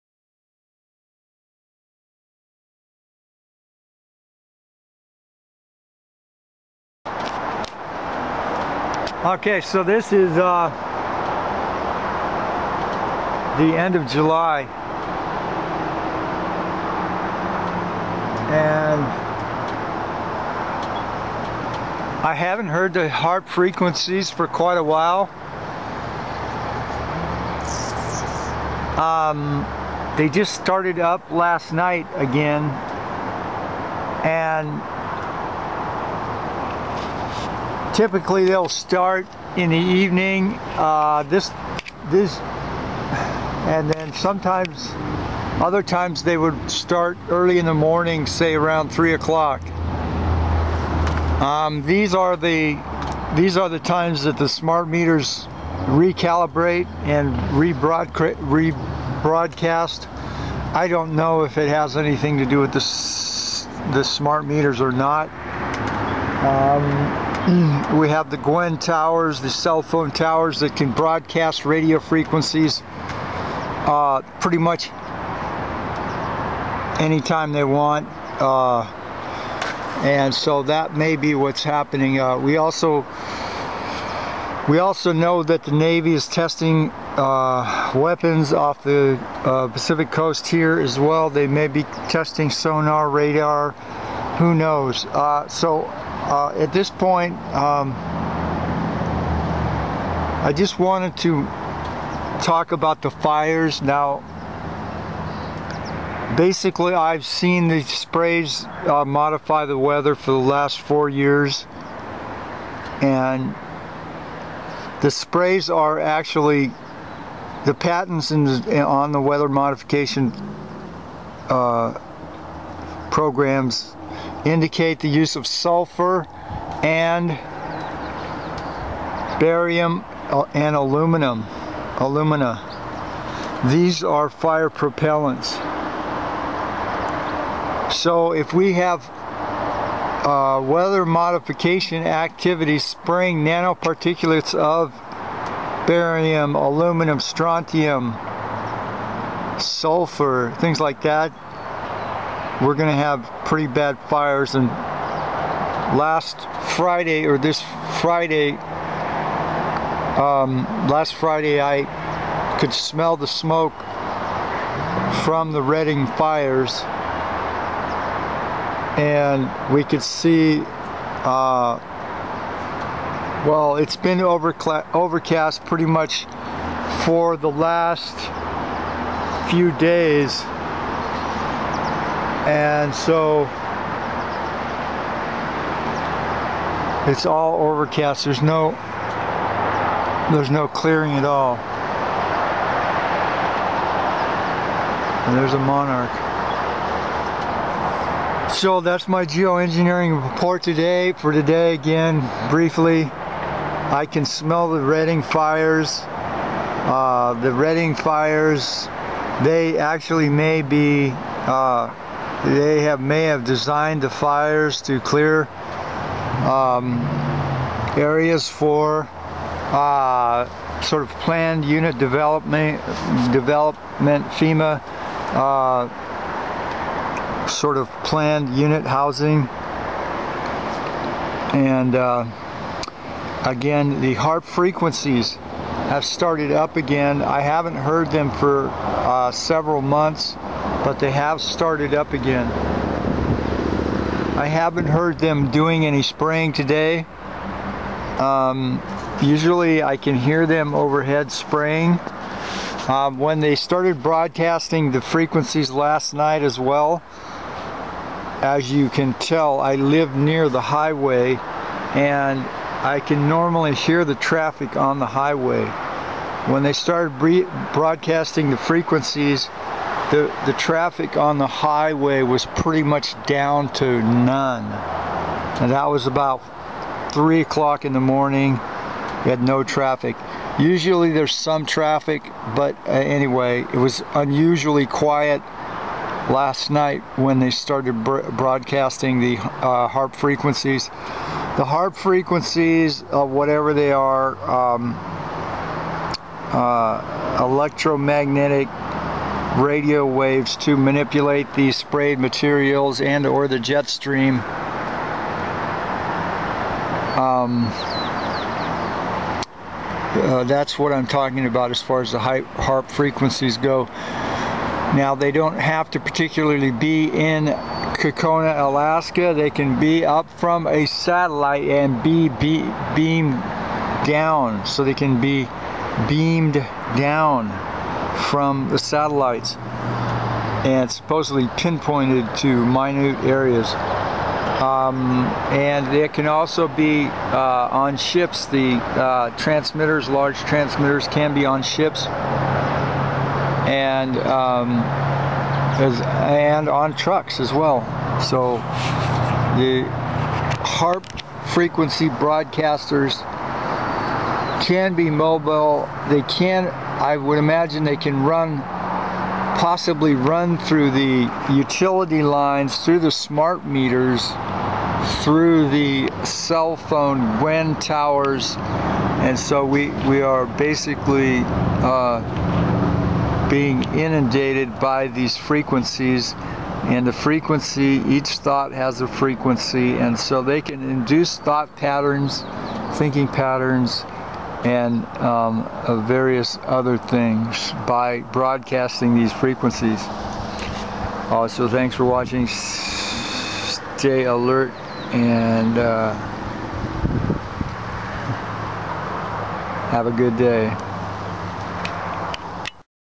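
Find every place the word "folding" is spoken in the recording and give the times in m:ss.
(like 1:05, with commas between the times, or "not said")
not said.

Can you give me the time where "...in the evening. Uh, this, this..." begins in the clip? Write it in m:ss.
0:39.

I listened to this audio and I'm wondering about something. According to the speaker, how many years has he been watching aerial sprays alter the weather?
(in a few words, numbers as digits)
4.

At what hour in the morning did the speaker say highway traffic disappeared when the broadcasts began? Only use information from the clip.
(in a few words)
3 o'clock.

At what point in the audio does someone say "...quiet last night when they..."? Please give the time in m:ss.
4:44.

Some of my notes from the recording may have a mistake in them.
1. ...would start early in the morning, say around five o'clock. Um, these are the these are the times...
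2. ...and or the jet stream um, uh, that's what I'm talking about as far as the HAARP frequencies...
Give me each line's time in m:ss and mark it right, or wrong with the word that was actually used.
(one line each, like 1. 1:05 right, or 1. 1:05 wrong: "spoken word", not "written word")
1. 0:46 wrong: "three", not "five"
2. 5:03 right.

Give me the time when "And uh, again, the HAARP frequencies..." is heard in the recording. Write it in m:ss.
3:51.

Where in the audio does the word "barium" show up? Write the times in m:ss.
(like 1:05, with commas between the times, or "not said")
2:09, 2:25.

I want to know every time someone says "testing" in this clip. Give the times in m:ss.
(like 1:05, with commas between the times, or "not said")
1:26, 1:32.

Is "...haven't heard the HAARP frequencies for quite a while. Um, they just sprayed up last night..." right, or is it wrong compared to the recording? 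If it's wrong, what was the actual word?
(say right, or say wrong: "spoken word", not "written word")
wrong: "started", not "sprayed".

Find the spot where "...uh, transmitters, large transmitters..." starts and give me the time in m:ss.
5:38.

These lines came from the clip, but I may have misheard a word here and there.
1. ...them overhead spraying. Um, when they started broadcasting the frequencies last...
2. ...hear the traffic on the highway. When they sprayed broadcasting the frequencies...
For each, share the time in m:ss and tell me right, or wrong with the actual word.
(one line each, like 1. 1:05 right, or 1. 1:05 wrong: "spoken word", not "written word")
1. 4:10 right
2. 4:23 wrong: "started", not "sprayed".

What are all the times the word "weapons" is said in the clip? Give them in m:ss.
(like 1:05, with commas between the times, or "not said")
1:27.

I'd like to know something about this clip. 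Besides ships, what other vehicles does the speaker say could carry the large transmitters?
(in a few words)
trucks.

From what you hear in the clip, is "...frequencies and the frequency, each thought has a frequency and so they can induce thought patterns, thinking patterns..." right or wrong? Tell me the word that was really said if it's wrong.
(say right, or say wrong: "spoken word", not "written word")
right.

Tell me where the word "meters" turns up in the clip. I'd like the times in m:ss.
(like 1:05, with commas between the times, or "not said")
0:54, 1:04, 6:03.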